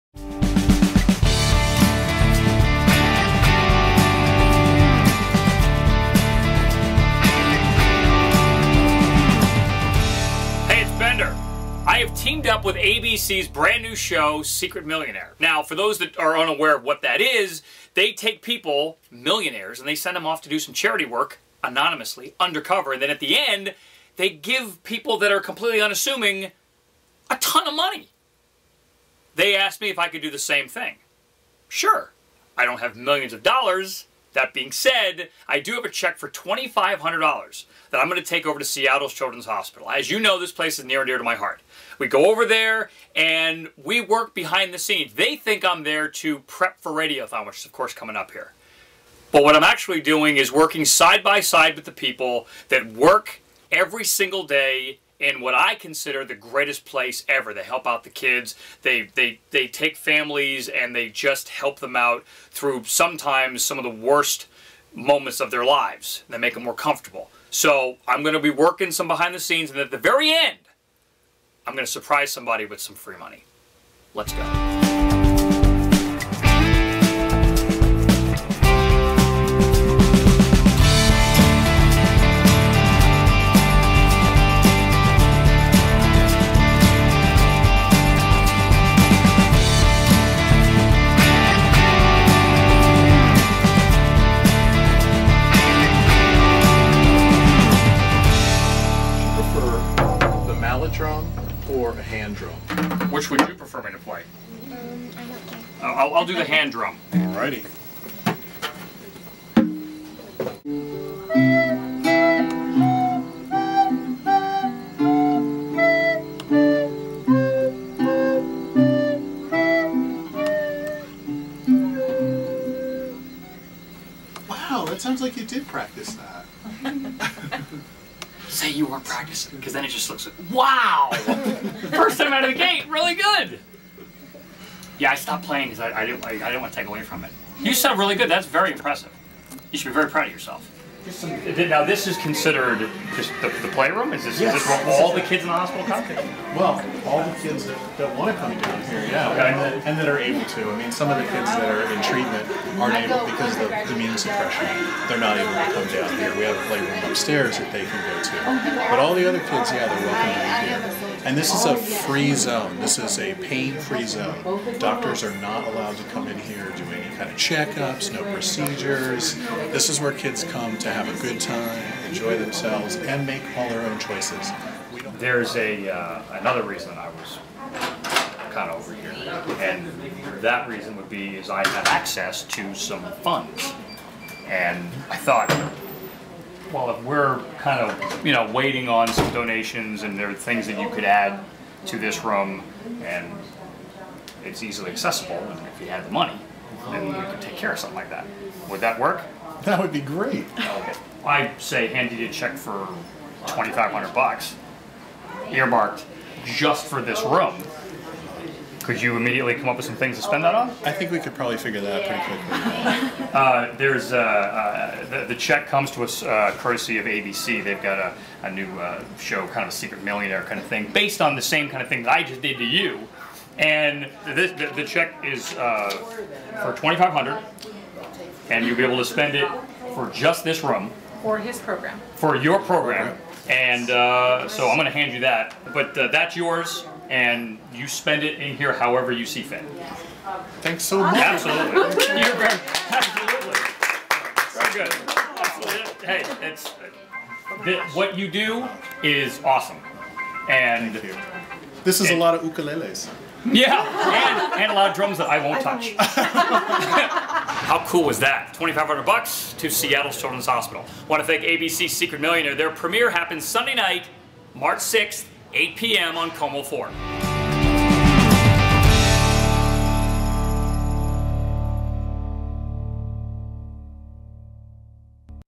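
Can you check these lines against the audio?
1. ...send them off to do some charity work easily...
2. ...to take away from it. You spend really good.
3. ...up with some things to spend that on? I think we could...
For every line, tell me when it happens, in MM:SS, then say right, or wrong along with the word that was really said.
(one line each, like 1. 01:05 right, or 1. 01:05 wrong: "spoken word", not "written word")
1. 00:19 wrong: "anonymously", not "easily"
2. 02:16 wrong: "sound", not "spend"
3. 03:29 right.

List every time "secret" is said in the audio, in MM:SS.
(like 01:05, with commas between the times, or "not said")
00:14, 03:39, 04:21.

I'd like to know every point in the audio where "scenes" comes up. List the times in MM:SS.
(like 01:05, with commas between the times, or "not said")
00:44, 01:09.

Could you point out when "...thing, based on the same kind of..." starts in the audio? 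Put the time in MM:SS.
03:40.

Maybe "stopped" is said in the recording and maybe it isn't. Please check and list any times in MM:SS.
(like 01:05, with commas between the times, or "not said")
02:15.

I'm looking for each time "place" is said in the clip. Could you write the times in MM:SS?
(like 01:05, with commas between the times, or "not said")
00:40, 00:56.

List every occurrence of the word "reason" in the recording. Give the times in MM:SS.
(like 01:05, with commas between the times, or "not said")
02:56, 03:00.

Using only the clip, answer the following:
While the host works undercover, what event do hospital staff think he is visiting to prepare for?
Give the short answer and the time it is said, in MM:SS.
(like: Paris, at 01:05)
Radiothon, at 00:46.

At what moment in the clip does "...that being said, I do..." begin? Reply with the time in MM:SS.
00:34.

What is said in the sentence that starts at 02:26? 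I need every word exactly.
Well, all the kids that, that want to come down here, yeah, okay.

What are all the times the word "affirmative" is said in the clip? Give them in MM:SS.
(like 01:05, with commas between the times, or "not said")
01:43.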